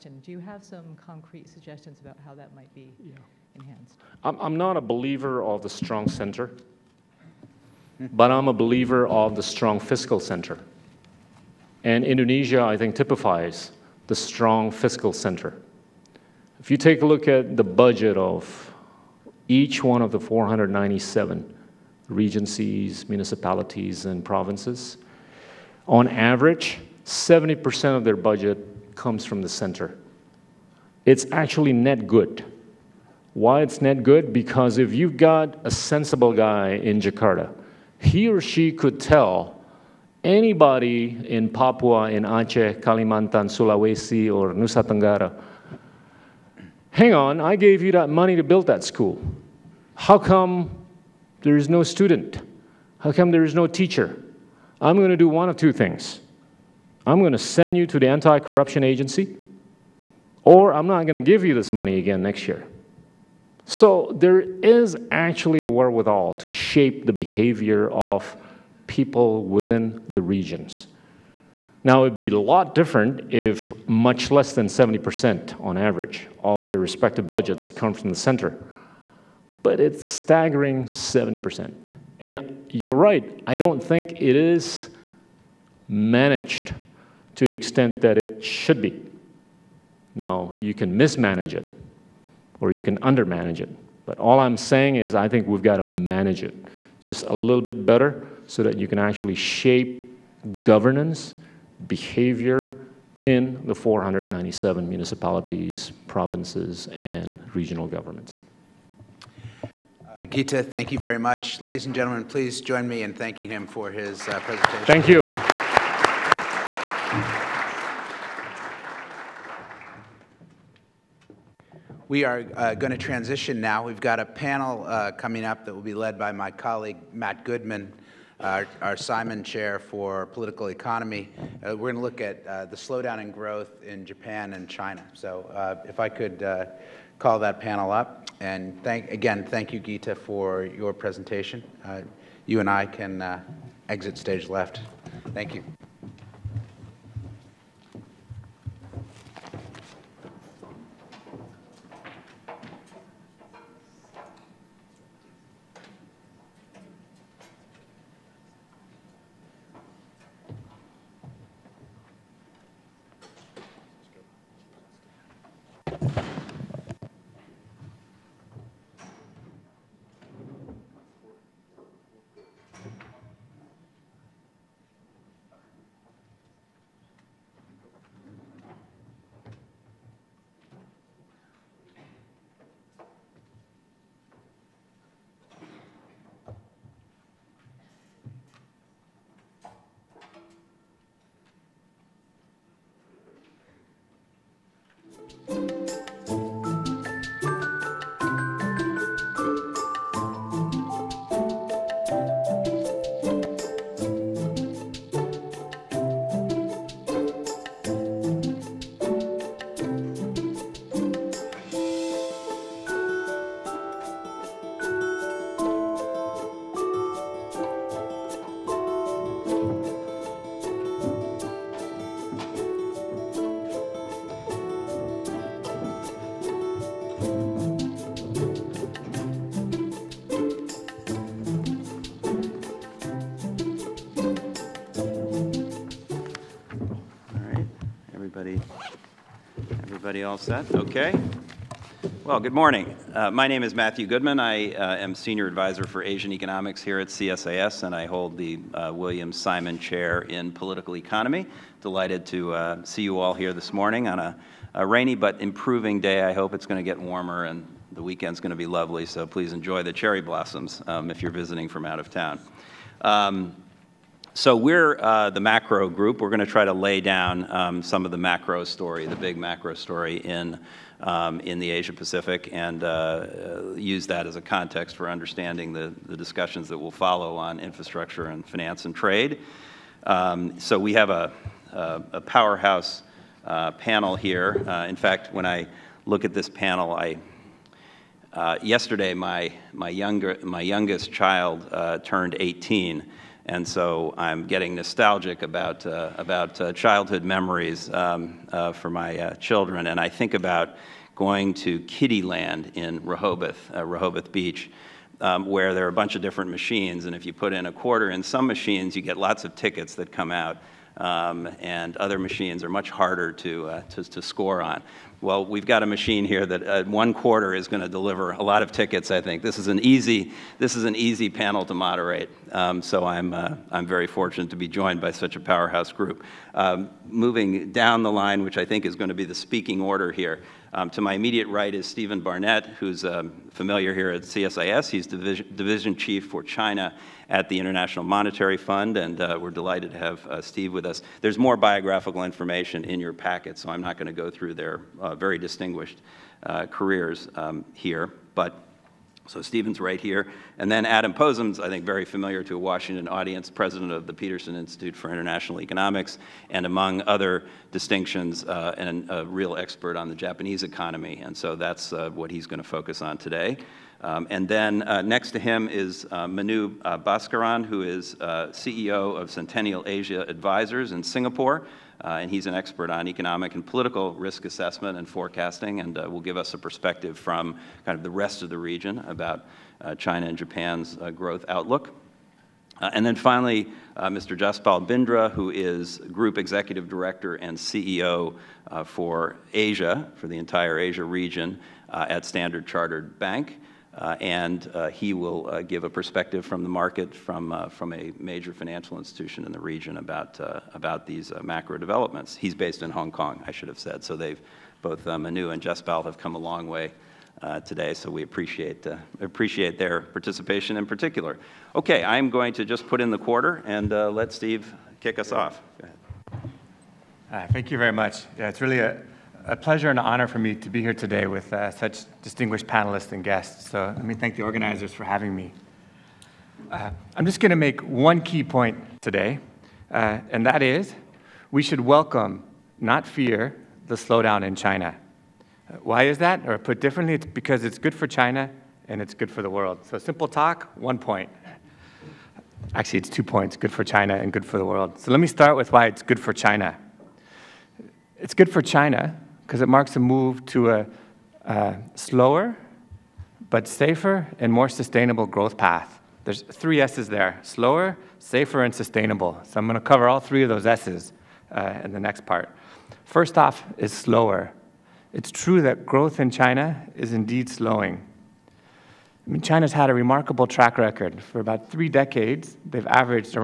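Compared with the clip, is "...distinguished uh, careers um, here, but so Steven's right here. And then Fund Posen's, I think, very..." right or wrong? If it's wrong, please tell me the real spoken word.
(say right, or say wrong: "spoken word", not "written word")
wrong: "Adam", not "Fund".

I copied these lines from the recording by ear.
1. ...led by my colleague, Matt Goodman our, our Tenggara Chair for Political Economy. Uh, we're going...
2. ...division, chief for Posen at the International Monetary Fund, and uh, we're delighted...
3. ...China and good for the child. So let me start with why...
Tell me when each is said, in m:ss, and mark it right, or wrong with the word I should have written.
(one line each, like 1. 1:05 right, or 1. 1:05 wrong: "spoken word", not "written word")
1. 2:05 wrong: "Simon", not "Tenggara"
2. 5:35 wrong: "China", not "Posen"
3. 7:23 wrong: "world", not "child".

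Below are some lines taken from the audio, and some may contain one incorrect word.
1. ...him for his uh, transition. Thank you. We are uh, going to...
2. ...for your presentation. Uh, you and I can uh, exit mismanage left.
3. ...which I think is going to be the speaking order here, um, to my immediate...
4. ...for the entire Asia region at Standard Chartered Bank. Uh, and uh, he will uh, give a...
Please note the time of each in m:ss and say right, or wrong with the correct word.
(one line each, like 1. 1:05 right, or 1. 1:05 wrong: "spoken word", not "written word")
1. 1:53 wrong: "presentation", not "transition"
2. 2:20 wrong: "stage", not "mismanage"
3. 5:28 right
4. 6:30 right.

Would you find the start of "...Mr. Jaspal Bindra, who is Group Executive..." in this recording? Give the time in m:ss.
6:24.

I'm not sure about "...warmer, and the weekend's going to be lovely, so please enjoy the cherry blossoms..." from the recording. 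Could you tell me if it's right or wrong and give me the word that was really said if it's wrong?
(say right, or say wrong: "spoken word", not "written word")
right.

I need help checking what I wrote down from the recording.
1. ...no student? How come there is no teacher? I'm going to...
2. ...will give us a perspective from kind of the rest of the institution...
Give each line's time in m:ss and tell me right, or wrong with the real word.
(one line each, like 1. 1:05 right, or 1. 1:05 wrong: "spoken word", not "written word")
1. 0:51 right
2. 6:16 wrong: "region", not "institution".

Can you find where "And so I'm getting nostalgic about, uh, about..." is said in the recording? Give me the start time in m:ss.
4:53.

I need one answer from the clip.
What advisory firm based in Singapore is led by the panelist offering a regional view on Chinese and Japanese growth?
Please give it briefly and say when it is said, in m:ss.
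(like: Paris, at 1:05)
Centennial Asia Advisors, at 6:09.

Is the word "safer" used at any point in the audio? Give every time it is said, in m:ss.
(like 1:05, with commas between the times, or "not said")
7:33, 7:38.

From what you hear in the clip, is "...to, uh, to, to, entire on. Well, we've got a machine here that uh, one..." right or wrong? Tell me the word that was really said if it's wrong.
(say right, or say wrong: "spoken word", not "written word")
wrong: "score", not "entire".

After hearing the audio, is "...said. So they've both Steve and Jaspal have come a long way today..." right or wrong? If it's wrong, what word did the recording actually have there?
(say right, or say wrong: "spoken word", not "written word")
wrong: "Manu", not "Steve".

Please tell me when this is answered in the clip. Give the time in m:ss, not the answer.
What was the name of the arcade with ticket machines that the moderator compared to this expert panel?
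5:01.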